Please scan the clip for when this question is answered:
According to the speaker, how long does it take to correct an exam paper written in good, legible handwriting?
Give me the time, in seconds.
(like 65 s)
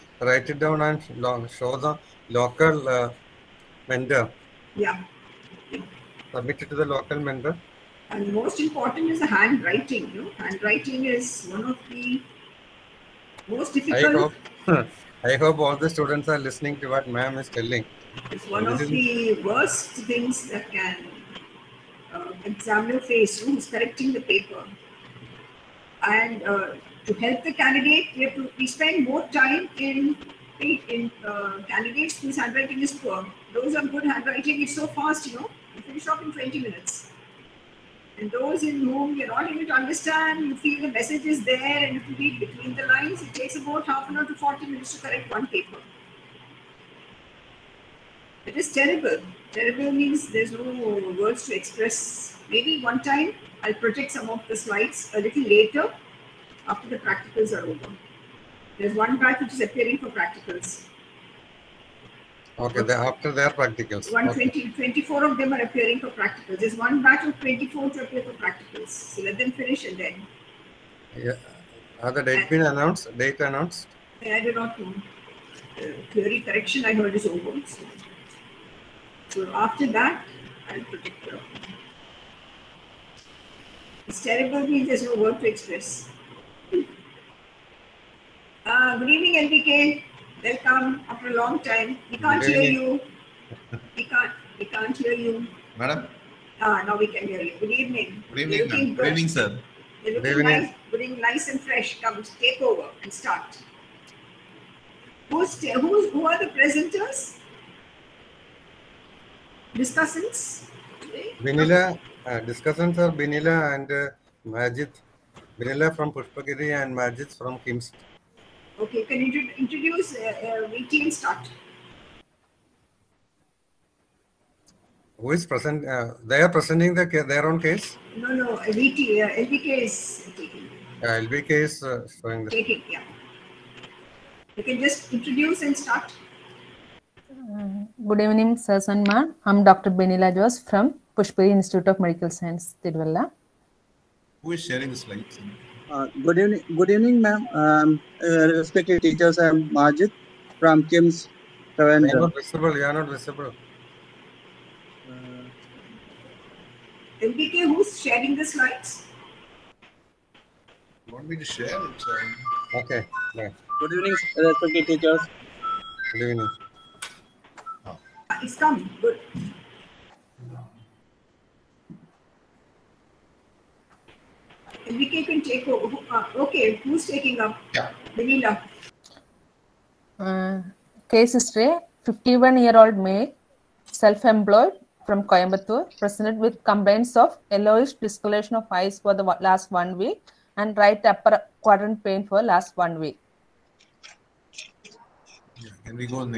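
36 s.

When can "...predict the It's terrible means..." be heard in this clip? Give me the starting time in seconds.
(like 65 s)
80 s.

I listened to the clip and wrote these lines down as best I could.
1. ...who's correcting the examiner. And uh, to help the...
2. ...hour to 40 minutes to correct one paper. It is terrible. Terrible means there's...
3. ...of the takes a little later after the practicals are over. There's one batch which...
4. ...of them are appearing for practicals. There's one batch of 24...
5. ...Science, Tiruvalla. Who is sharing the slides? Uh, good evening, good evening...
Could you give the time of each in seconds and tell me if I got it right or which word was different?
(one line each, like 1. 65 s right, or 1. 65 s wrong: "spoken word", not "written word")
1. 23 s wrong: "paper", not "examiner"
2. 44 s right
3. 54 s wrong: "slides", not "takes"
4. 65 s right
5. 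142 s right.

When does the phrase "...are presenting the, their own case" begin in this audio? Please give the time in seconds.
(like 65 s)
126 s.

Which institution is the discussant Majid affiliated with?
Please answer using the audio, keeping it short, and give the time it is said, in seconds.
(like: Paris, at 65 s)
Kimston, at 117 s.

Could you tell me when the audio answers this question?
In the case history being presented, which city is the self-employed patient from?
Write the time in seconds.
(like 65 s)
185 s.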